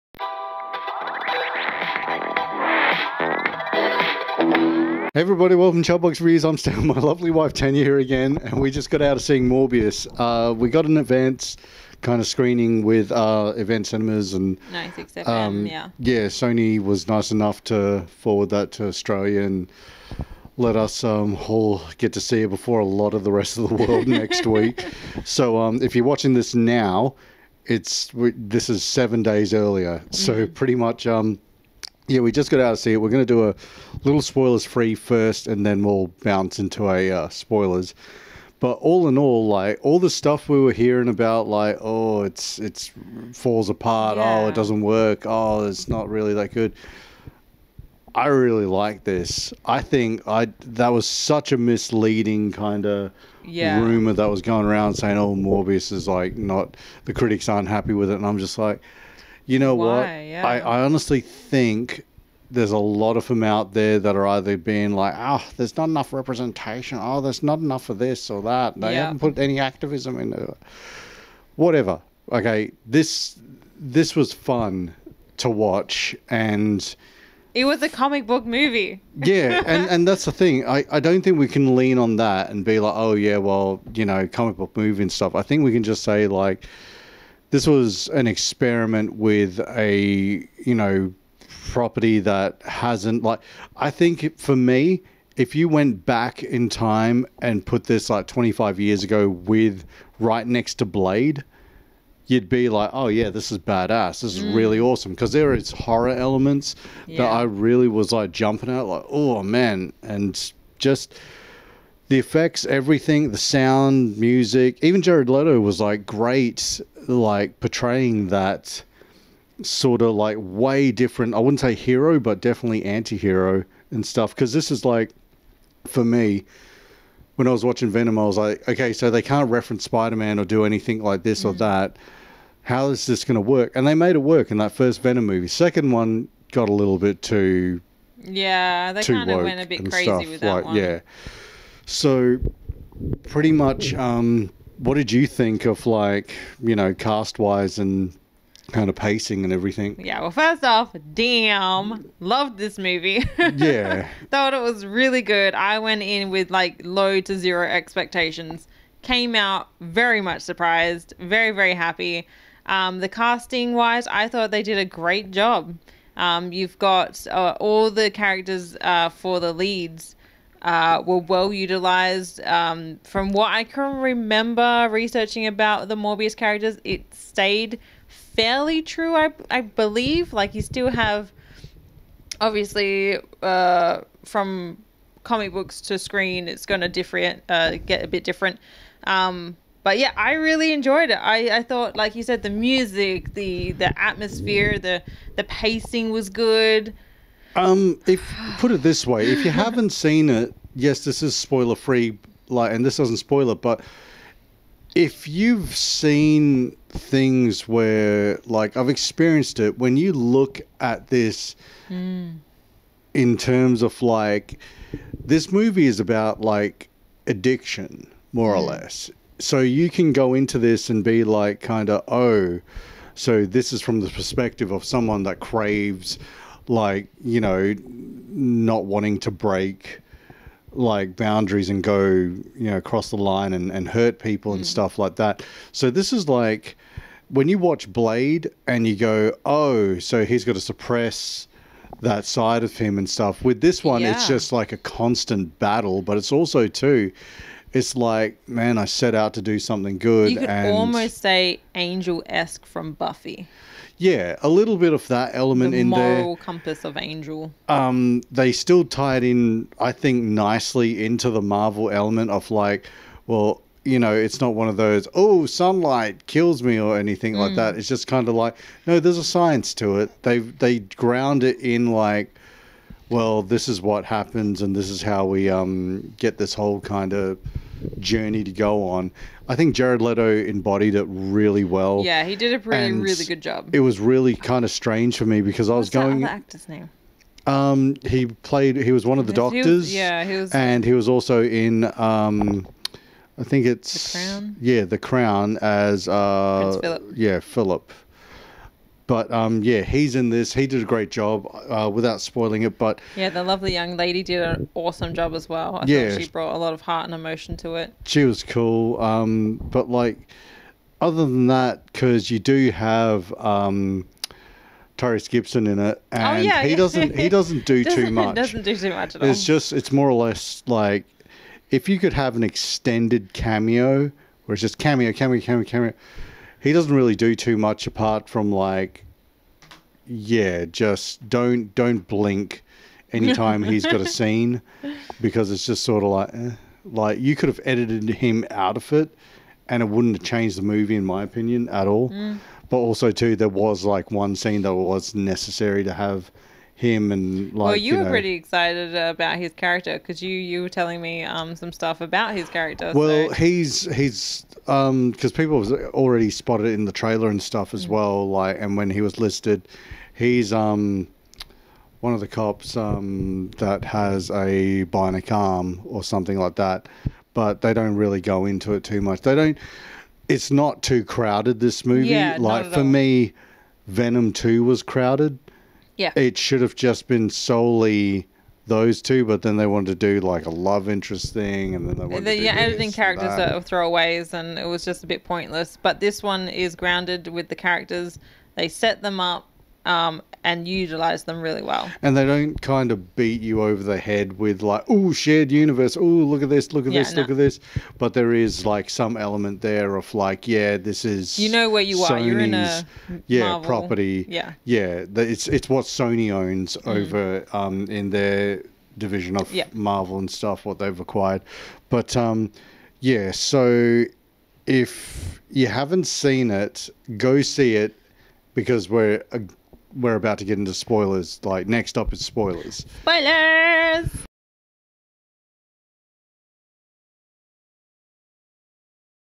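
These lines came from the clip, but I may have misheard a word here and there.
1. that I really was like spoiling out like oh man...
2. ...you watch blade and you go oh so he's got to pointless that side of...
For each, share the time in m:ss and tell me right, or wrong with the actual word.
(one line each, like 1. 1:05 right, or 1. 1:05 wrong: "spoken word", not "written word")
1. 1:47 wrong: "jumping", not "spoiling"
2. 3:57 wrong: "suppress", not "pointless".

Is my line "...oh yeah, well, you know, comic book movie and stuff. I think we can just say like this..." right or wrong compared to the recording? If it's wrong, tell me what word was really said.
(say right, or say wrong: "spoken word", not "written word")
right.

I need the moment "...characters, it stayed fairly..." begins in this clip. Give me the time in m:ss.
2:56.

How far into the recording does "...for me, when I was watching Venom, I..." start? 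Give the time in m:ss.
2:05.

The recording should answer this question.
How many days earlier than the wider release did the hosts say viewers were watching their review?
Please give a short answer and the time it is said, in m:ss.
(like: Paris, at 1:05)
7, at 0:28.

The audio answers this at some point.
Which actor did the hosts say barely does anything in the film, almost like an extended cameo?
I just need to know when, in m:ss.
5:14.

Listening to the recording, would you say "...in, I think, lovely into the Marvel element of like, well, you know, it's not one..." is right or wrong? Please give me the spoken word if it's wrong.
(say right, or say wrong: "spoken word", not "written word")
wrong: "nicely", not "lovely".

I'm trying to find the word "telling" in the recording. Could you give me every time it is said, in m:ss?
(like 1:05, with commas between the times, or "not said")
5:50.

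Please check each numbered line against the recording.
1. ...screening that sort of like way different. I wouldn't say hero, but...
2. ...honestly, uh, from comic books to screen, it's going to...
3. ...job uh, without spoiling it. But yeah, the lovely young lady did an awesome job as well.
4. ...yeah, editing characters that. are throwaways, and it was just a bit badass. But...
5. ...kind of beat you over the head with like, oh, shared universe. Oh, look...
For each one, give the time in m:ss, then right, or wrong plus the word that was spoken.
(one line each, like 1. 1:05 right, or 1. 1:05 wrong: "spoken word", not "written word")
1. 1:57 wrong: "portraying", not "screening"
2. 3:02 wrong: "obviously", not "honestly"
3. 5:01 right
4. 6:22 wrong: "pointless", not "badass"
5. 6:32 right.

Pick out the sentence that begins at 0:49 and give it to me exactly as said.
I think I that was such a misleading kind of yeah.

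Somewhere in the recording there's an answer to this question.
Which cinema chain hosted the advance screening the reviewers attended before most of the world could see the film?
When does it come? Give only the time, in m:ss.
0:13.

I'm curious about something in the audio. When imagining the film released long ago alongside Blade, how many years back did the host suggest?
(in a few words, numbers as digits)
25 years.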